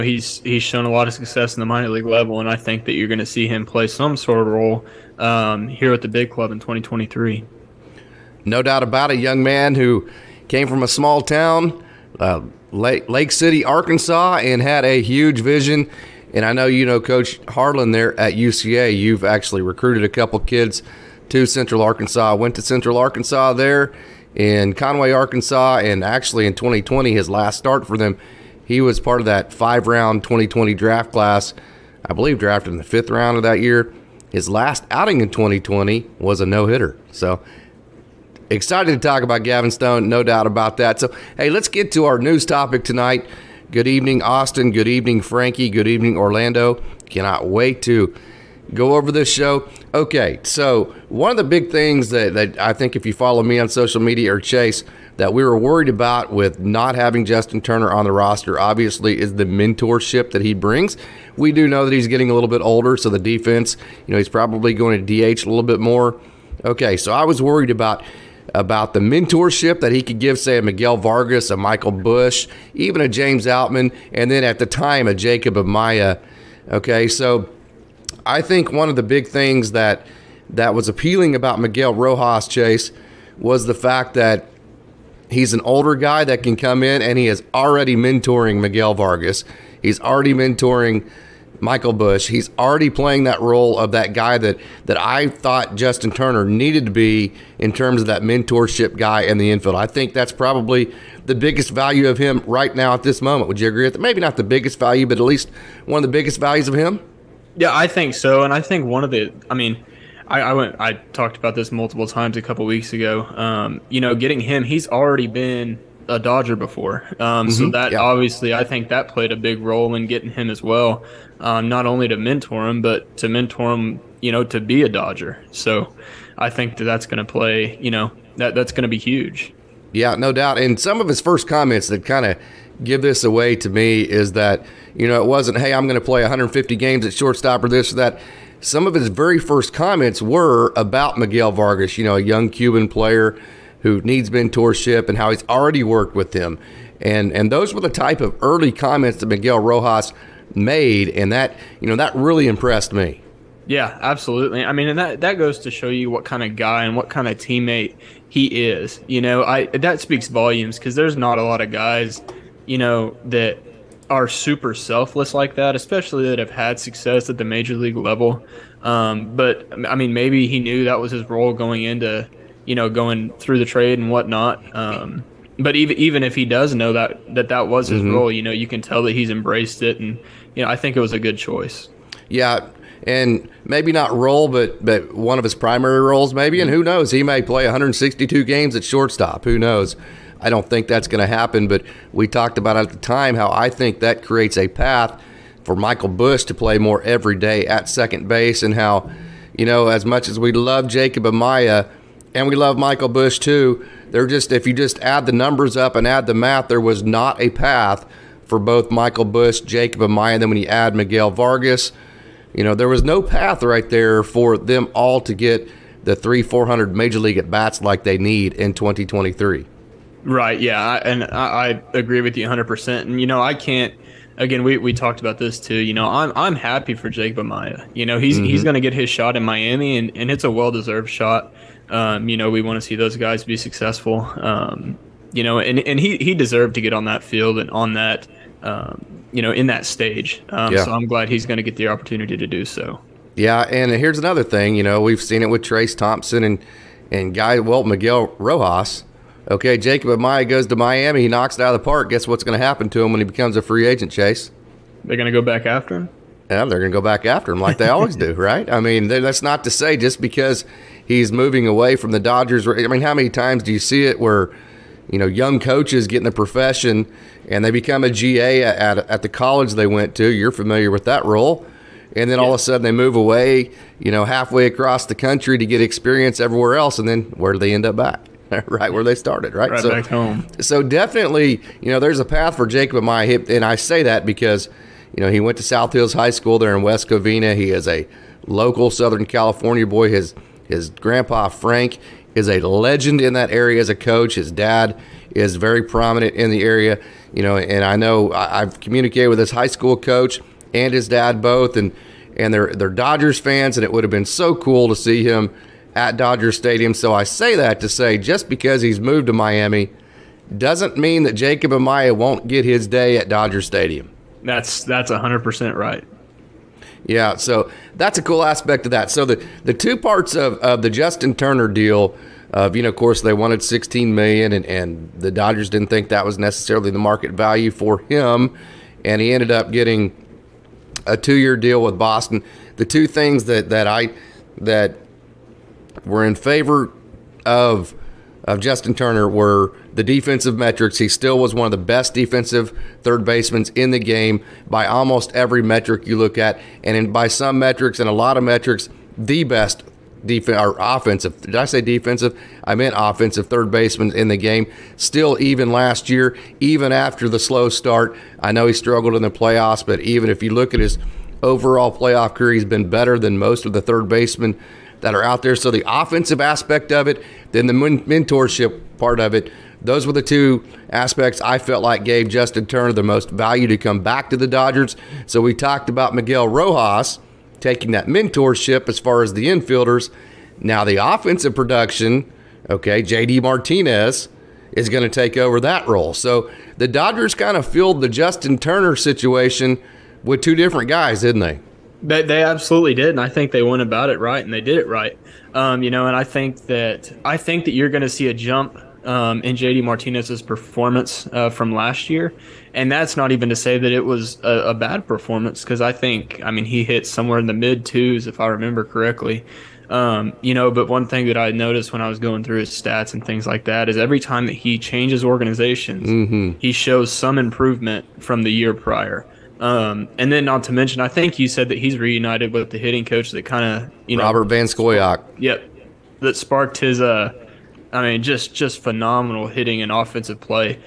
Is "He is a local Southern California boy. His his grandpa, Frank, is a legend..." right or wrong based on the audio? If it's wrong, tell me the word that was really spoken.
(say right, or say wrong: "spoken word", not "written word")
right.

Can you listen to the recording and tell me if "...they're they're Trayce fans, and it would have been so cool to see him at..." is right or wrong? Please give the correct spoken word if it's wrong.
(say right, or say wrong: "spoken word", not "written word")
wrong: "Dodgers", not "Trayce".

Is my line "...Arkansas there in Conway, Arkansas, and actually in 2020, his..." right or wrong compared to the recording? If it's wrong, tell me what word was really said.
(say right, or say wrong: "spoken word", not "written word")
right.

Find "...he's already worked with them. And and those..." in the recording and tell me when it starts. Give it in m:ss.
2:25.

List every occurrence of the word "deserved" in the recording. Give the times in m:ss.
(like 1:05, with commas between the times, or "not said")
3:50, 3:56.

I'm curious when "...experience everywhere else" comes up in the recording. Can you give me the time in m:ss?
4:35.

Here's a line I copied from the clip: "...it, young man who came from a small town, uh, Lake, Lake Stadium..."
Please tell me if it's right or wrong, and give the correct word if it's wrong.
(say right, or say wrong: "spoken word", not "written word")
wrong: "City", not "Stadium".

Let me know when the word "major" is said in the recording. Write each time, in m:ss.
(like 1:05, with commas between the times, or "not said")
2:47, 3:36.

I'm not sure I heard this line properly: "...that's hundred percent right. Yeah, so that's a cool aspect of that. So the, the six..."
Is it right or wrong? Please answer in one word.
wrong.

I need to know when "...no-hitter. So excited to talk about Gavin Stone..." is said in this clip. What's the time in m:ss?
0:36.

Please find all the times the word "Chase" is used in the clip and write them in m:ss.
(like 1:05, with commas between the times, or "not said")
0:54, 1:22, 4:14.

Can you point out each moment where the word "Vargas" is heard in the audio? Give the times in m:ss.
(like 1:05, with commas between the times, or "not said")
1:10, 1:28, 2:21, 3:31.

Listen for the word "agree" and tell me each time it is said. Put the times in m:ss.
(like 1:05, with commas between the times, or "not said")
1:43, 3:41.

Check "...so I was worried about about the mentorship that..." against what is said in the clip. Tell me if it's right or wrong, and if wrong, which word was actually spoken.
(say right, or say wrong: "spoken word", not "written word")
right.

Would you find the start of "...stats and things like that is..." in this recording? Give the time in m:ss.
6:52.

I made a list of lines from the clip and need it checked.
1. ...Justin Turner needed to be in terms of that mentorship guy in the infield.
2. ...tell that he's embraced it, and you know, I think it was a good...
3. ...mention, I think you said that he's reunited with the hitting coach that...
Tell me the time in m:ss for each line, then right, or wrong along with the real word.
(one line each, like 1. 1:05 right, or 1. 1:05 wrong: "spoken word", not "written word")
1. 1:35 right
2. 2:58 right
3. 7:00 right.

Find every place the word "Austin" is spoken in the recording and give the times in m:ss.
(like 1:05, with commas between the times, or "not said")
0:44.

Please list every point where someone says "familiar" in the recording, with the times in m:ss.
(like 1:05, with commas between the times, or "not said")
4:30.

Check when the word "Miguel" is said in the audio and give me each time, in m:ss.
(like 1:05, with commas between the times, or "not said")
1:10, 1:21, 1:28, 2:21, 2:29, 3:30, 4:07, 6:16.